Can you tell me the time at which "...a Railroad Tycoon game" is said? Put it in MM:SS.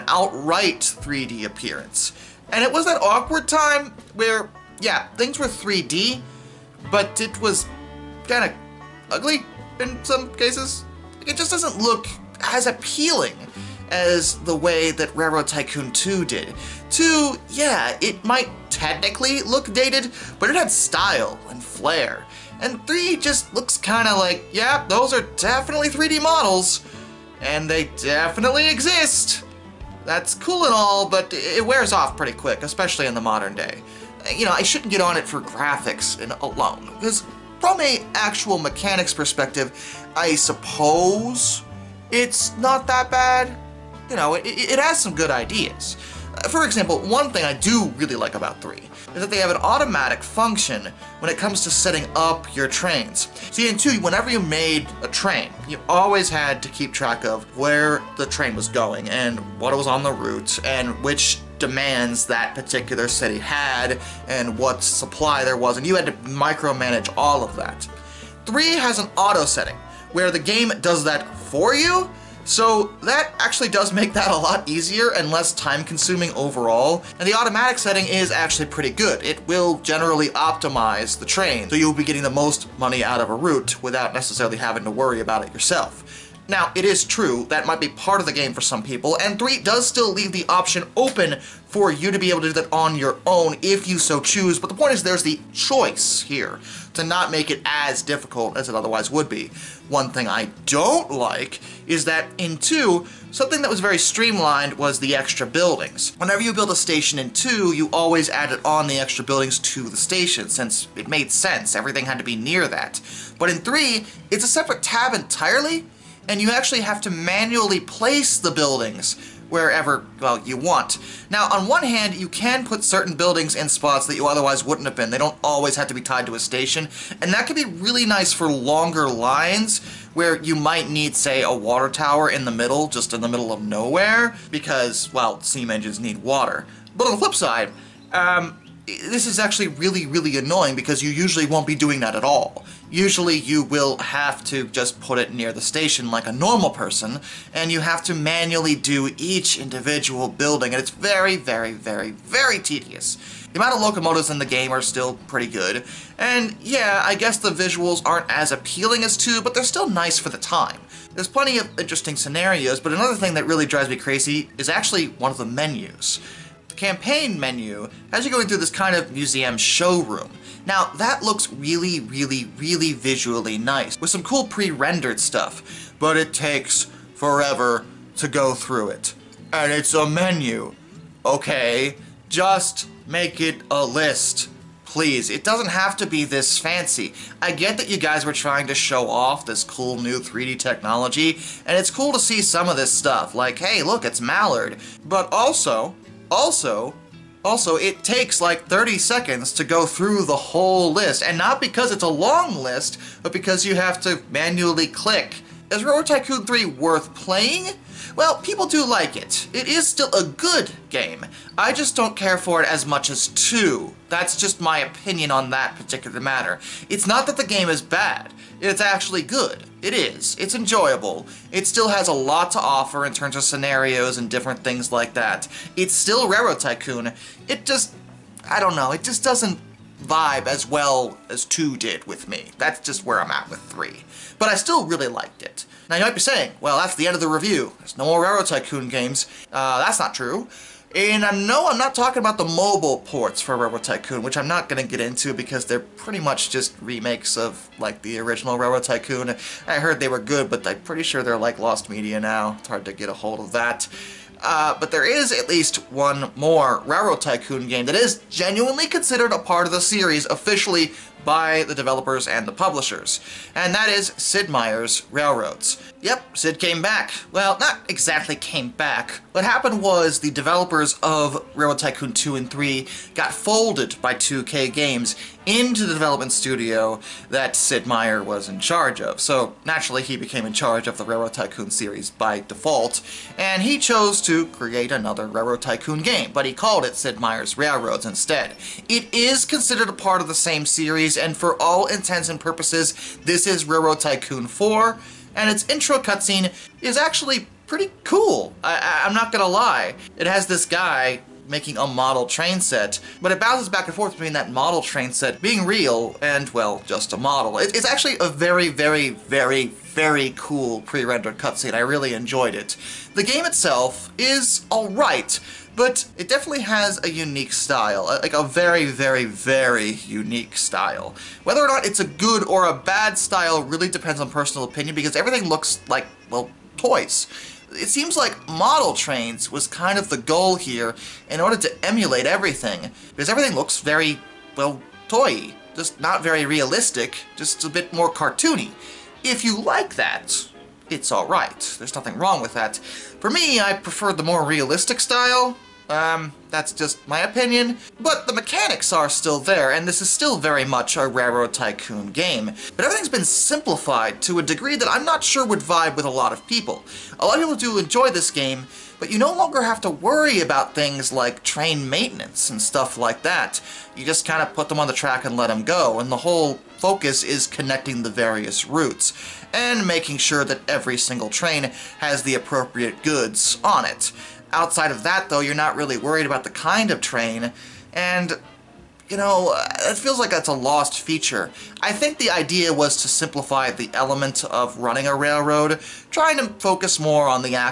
05:50.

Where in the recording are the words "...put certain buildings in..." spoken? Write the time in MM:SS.
02:02.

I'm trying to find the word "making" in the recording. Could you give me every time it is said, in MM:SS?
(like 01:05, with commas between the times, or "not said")
05:01, 06:09.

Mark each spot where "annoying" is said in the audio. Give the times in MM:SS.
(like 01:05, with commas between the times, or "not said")
02:20.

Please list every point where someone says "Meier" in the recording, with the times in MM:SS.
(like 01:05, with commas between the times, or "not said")
04:24, 04:37, 04:47.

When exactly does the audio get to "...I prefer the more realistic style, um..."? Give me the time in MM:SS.
05:43.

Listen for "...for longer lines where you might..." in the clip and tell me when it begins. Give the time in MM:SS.
02:08.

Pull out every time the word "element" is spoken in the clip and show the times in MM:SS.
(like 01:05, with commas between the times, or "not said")
06:23.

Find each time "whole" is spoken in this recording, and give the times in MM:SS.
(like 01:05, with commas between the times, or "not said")
03:20, 06:06.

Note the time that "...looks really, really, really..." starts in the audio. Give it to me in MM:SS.
02:51.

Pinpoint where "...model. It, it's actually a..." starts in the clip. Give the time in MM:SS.
05:07.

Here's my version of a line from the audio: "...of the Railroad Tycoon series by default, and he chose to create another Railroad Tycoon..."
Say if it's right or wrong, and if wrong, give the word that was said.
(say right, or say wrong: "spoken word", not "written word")
right.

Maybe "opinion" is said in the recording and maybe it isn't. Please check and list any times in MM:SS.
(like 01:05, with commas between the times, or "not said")
03:34, 05:24, 05:47.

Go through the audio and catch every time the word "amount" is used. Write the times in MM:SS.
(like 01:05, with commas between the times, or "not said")
02:33.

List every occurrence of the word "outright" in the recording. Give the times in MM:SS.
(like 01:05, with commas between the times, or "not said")
00:00.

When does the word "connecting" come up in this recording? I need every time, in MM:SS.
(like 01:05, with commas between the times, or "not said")
06:07.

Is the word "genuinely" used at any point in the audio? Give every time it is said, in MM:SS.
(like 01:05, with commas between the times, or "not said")
04:18.